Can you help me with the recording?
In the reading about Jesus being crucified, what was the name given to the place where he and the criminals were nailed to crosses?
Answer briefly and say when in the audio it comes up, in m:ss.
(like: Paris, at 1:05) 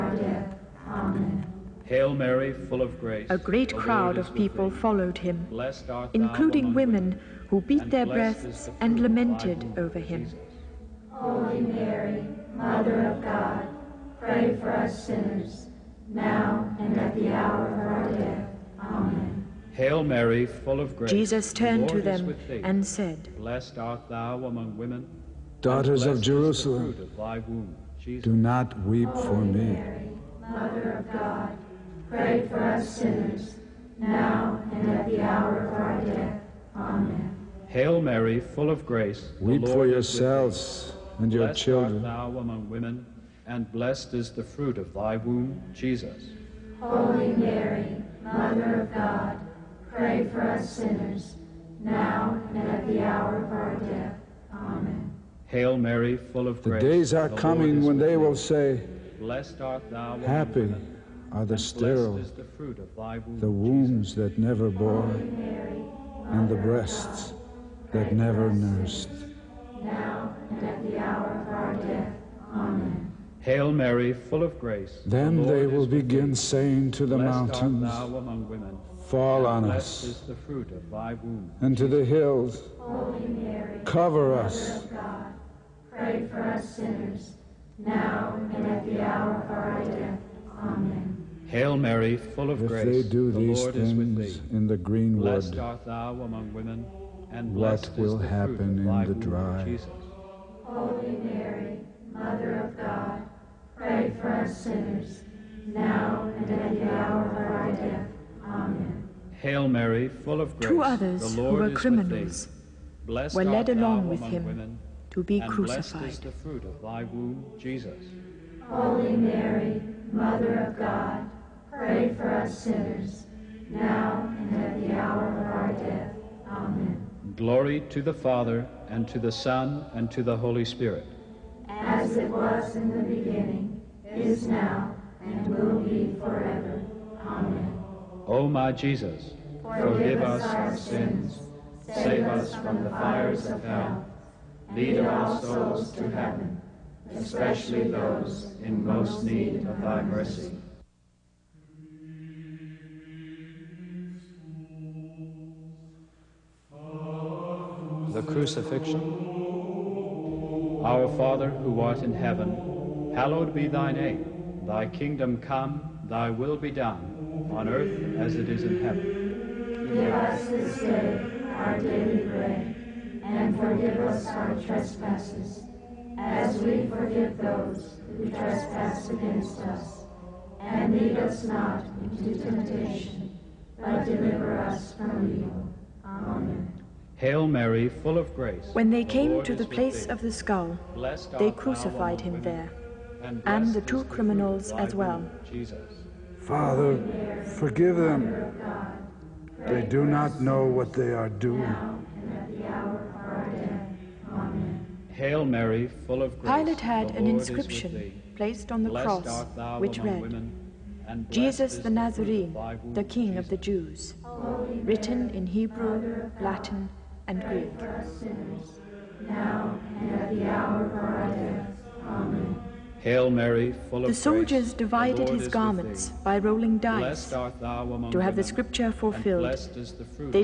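the place of the skull, at 3:09.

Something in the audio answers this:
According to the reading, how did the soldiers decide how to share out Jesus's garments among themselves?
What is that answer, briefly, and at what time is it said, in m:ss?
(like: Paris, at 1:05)
rolling dice, at 3:46.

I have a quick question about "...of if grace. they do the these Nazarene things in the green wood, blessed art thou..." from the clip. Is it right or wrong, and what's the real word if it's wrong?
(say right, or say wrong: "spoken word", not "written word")
wrong: "Lord", not "Nazarene".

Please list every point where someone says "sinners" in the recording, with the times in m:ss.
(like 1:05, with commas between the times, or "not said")
0:15, 0:32, 0:50, 1:26, 1:44, 2:02, 3:38.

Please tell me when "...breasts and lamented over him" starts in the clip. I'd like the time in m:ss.
0:08.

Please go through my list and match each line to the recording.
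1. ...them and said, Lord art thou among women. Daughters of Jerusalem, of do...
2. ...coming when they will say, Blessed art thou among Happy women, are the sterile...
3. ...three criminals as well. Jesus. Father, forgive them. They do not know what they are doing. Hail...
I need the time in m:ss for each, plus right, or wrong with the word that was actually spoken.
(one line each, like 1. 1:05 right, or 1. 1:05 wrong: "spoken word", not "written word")
1. 0:22 wrong: "Blessed", not "Lord"
2. 0:57 right
3. 3:13 wrong: "two", not "three".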